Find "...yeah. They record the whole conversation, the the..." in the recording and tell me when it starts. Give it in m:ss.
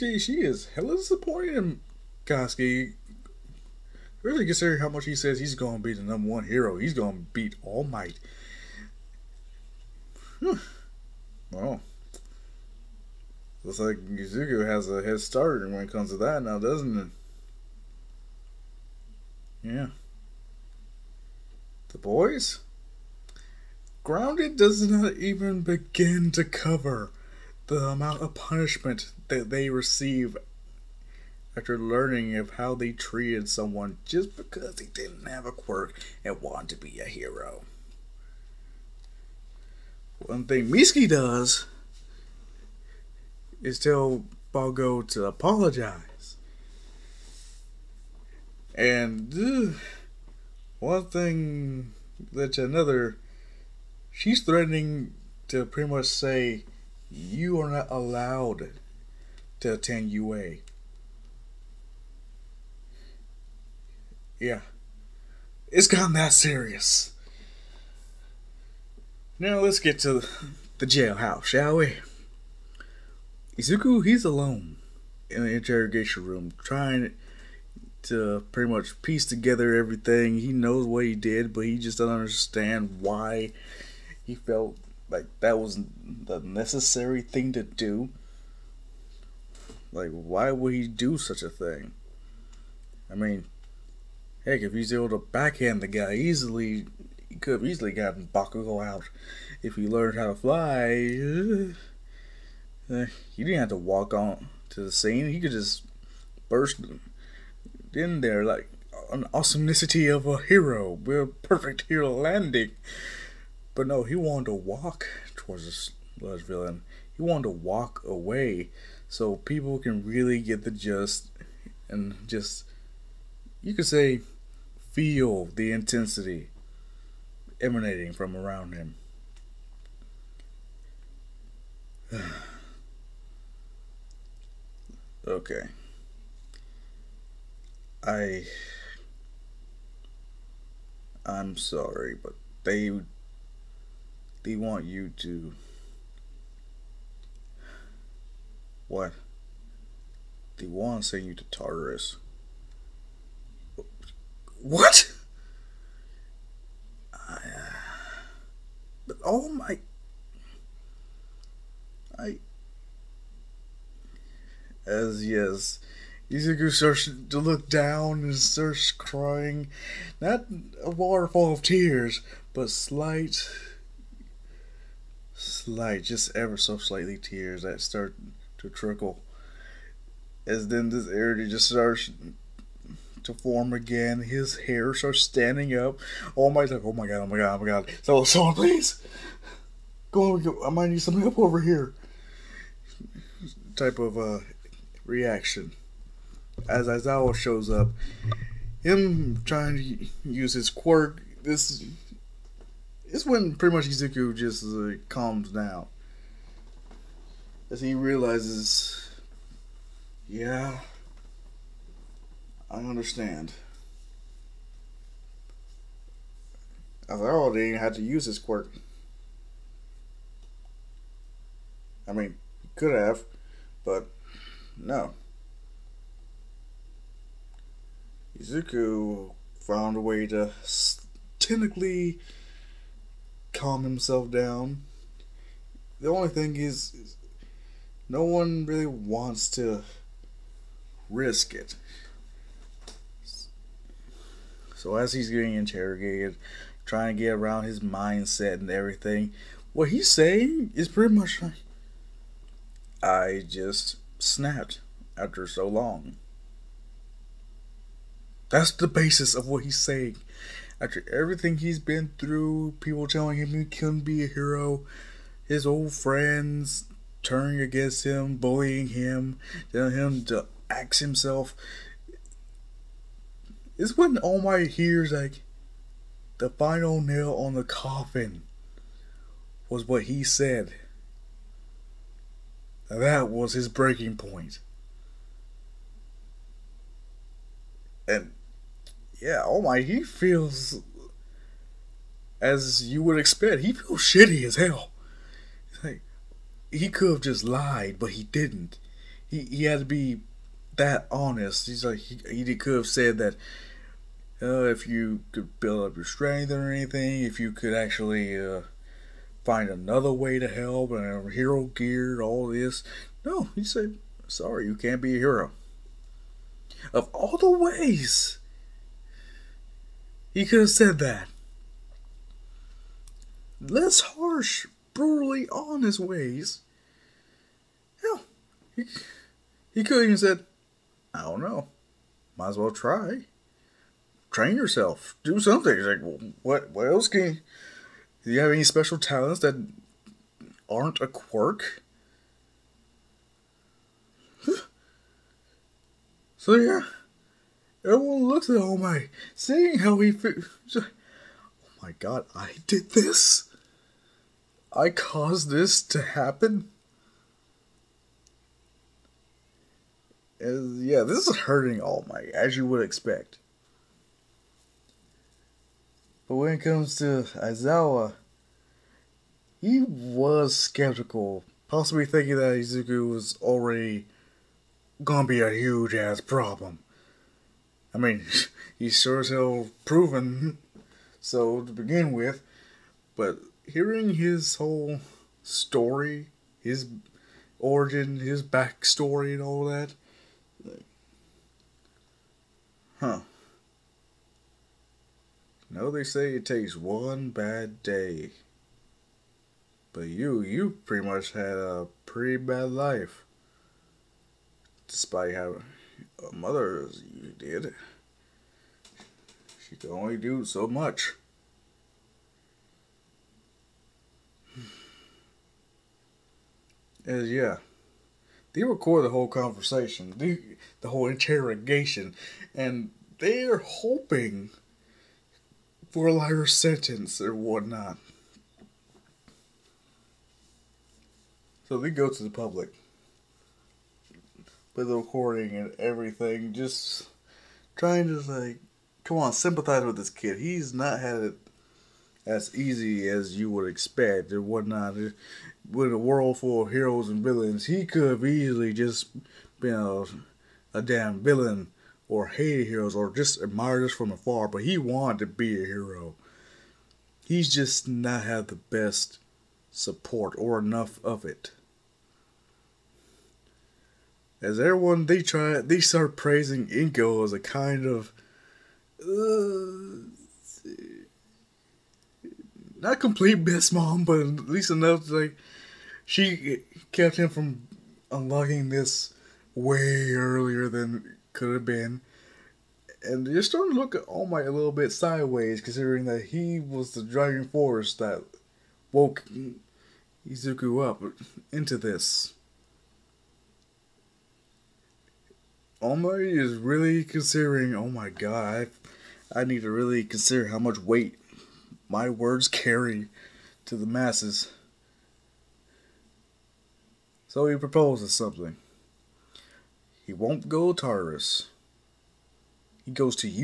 6:57.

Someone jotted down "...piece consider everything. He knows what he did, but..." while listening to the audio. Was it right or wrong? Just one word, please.
wrong.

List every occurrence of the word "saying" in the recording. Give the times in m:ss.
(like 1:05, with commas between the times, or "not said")
4:10, 4:19.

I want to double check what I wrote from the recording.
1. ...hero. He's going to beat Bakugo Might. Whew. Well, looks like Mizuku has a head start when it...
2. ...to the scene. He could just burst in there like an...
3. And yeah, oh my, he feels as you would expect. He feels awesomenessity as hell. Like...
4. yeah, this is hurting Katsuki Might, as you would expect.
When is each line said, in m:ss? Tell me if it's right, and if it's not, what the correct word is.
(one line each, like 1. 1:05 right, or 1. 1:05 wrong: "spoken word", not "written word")
1. 0:06 wrong: "All", not "Bakugo"
2. 1:44 right
3. 4:48 wrong: "shitty", not "awesomenessity"
4. 6:00 wrong: "All", not "Katsuki".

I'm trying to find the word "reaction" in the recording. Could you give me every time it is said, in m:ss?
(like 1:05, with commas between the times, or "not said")
3:15.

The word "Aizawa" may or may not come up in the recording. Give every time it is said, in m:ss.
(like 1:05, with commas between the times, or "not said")
3:16, 6:07.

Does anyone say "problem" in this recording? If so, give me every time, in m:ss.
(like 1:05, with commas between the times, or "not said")
6:16.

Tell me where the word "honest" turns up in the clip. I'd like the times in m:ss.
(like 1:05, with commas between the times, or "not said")
5:01.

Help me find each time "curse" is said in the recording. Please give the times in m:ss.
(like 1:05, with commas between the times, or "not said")
not said.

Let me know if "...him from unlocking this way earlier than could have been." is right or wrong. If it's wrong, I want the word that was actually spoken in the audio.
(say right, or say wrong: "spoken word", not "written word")
right.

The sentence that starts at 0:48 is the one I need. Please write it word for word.
And ugh, one thing that's another, she's threatening to pretty much say, you are not allowed to attend UA.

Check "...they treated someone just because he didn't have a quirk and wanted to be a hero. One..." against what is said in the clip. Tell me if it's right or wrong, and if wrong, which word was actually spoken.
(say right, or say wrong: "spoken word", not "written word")
right.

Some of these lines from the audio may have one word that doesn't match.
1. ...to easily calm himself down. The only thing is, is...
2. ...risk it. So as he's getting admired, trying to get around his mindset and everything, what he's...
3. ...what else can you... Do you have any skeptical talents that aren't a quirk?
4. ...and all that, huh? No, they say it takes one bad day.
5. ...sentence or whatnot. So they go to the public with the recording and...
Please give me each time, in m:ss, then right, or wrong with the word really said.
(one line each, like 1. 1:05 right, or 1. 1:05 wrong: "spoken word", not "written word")
1. 3:50 wrong: "technically", not "easily"
2. 4:01 wrong: "interrogated", not "admired"
3. 5:36 wrong: "special", not "skeptical"
4. 6:29 right
5. 7:06 right.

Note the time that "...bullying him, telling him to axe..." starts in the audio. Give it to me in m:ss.
4:28.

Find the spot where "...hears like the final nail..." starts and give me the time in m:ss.
4:34.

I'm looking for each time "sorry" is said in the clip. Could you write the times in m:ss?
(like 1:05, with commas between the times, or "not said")
2:21, 5:14.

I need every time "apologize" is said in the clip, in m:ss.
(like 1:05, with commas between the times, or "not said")
0:45.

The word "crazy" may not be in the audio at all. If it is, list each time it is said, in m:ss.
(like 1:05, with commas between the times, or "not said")
not said.